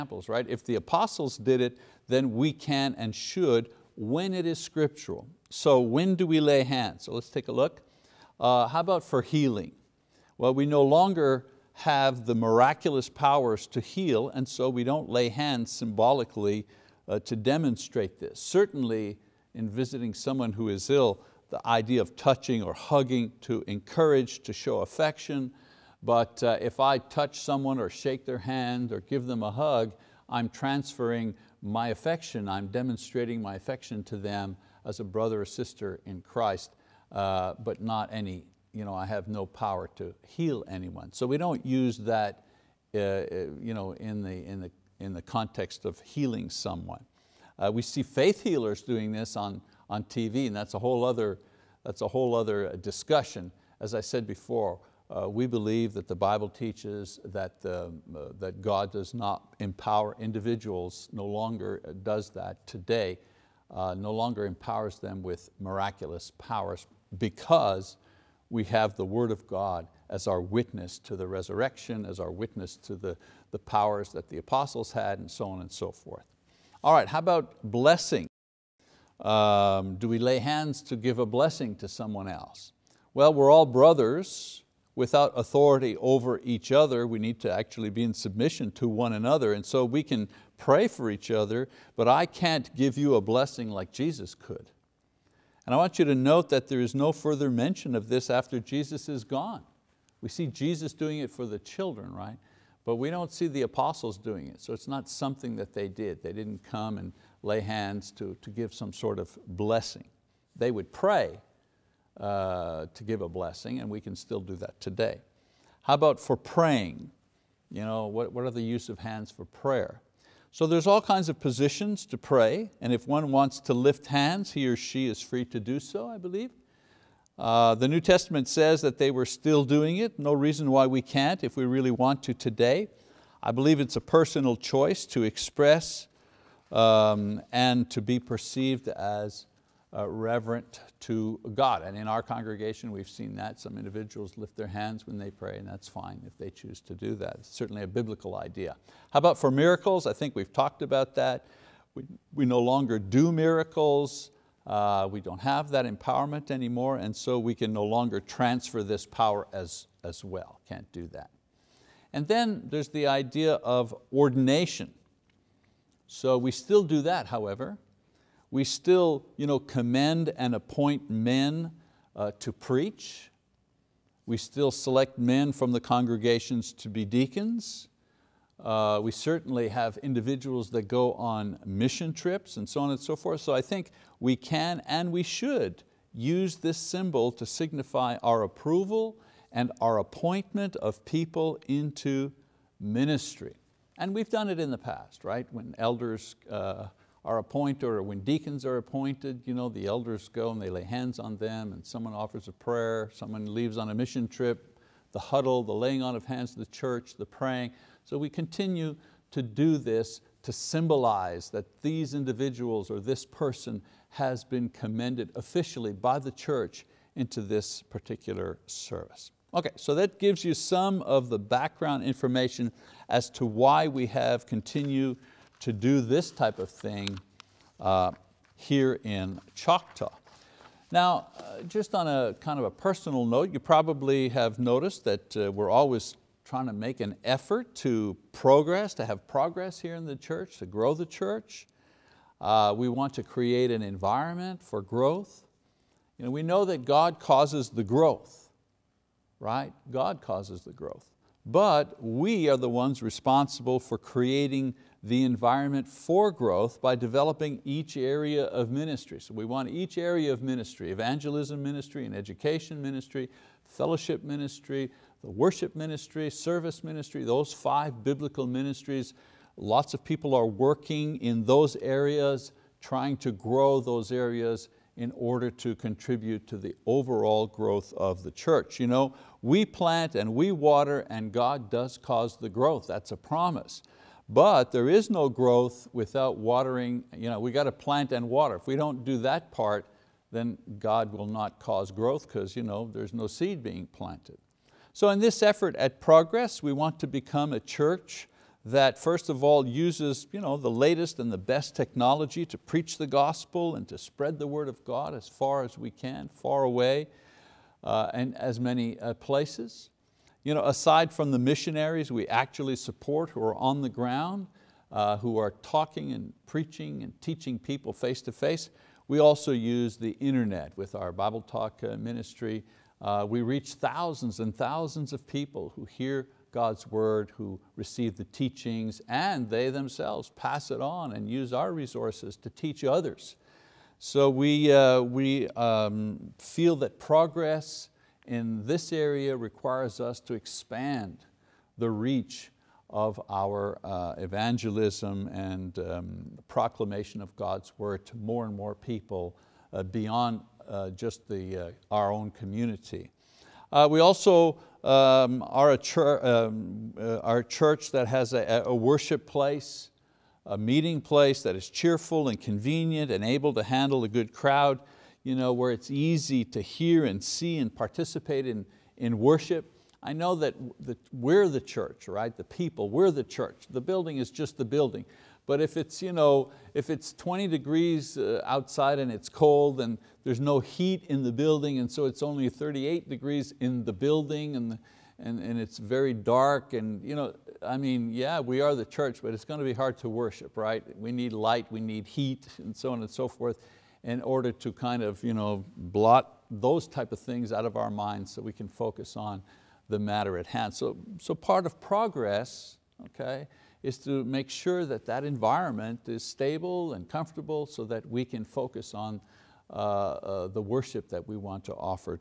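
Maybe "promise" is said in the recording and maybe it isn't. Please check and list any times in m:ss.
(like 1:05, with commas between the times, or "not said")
4:43.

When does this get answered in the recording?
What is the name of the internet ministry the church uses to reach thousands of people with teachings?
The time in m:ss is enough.
5:21.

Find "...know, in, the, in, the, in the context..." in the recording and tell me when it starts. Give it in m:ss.
0:43.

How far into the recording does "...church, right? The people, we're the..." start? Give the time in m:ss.
6:11.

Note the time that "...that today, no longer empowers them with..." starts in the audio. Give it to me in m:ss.
1:02.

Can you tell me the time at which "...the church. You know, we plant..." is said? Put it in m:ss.
4:38.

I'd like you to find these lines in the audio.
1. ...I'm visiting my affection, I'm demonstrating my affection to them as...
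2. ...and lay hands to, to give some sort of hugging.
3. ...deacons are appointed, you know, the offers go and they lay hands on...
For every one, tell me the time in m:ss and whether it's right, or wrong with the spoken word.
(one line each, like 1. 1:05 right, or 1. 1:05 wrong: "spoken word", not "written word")
1. 0:30 wrong: "transferring", not "visiting"
2. 1:46 wrong: "blessing", not "hugging"
3. 3:18 wrong: "elders", not "offers".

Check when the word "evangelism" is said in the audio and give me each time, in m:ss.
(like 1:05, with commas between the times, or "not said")
4:20, 5:44.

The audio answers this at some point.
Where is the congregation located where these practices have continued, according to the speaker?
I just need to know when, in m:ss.
3:49.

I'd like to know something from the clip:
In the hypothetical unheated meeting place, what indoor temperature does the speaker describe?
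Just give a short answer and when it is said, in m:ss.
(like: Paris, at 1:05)
38 degrees, at 6:22.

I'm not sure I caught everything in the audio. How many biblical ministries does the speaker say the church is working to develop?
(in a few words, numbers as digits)
5.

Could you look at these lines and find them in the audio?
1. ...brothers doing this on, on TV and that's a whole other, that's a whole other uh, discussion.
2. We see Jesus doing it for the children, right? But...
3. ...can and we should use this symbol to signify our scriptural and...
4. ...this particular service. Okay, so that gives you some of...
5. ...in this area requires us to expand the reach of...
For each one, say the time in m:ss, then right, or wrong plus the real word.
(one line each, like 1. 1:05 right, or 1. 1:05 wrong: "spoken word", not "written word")
1. 0:48 wrong: "healers", not "brothers"
2. 1:40 right
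3. 3:04 wrong: "approval", not "scriptural"
4. 3:37 right
5. 5:38 right.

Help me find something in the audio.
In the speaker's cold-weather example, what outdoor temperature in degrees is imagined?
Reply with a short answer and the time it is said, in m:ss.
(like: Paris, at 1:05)
20 degrees, at 6:17.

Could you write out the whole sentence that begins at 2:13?
I believe it's a personal choice to express um, and to be perceived as uh, reverent to God.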